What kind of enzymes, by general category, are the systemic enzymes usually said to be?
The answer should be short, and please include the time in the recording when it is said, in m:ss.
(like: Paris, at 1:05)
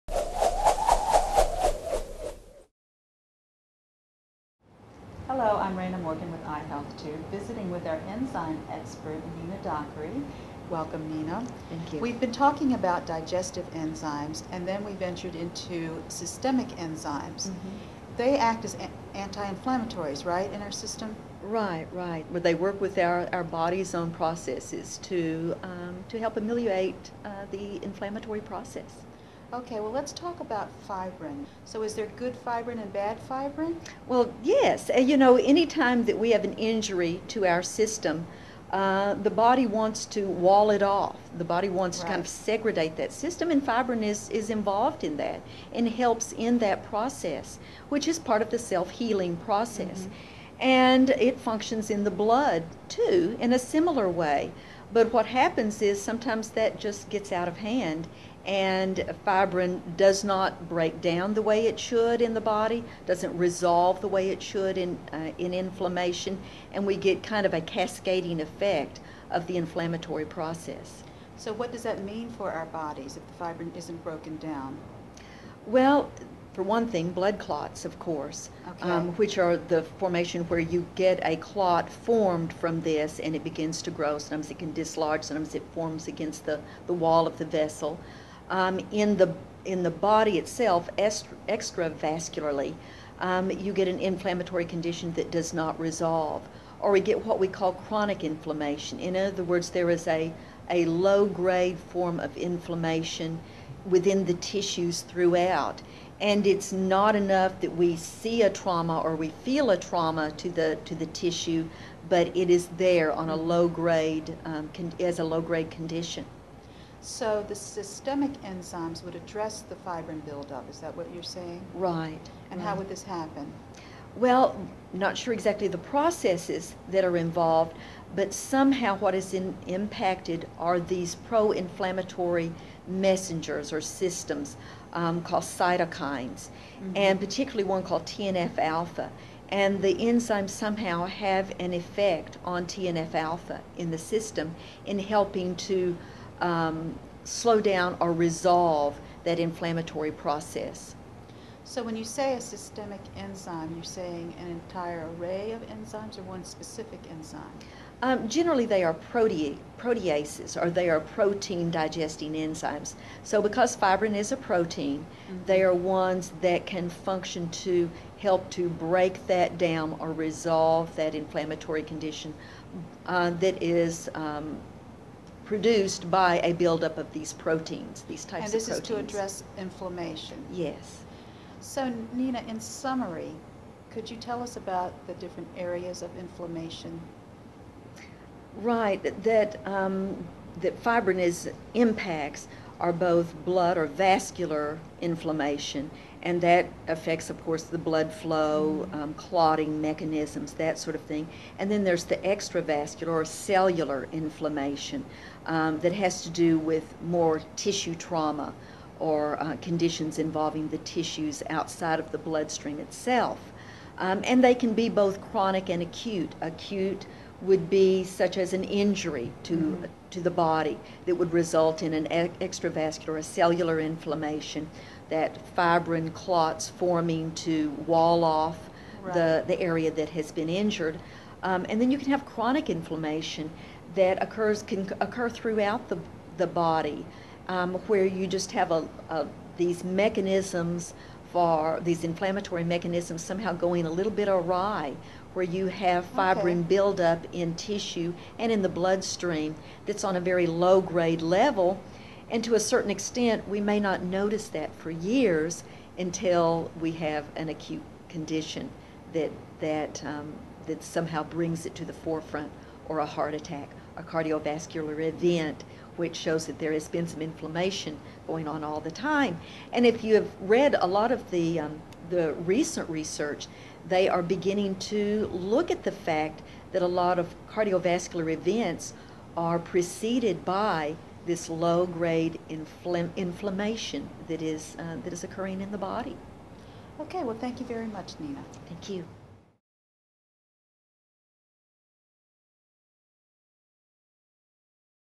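Proteases, at 2:39.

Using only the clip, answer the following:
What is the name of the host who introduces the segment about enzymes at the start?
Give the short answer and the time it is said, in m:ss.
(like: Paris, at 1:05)
Raina Morgan, at 0:05.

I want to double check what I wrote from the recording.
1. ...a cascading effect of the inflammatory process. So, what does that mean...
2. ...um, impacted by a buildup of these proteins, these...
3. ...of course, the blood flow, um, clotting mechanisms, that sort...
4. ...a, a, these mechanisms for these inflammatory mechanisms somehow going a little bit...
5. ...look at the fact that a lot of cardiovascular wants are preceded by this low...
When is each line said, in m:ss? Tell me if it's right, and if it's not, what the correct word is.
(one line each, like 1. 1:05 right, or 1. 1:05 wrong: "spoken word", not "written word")
1. 1:07 right
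2. 2:54 wrong: "produced", not "impacted"
3. 3:17 right
4. 3:58 right
5. 4:35 wrong: "events", not "wants".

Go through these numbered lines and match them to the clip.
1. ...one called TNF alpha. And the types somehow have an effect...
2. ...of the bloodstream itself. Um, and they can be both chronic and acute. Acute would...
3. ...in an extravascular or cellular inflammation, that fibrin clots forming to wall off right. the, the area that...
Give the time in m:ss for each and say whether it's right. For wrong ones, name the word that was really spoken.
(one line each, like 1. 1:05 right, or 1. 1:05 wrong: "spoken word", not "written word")
1. 2:17 wrong: "enzymes", not "types"
2. 3:31 right
3. 3:41 right.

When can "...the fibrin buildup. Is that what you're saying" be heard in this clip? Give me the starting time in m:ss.
1:59.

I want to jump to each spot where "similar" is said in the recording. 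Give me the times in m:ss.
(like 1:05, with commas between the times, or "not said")
0:53.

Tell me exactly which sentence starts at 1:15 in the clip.
Well, for one thing, blood clots, of course, okay.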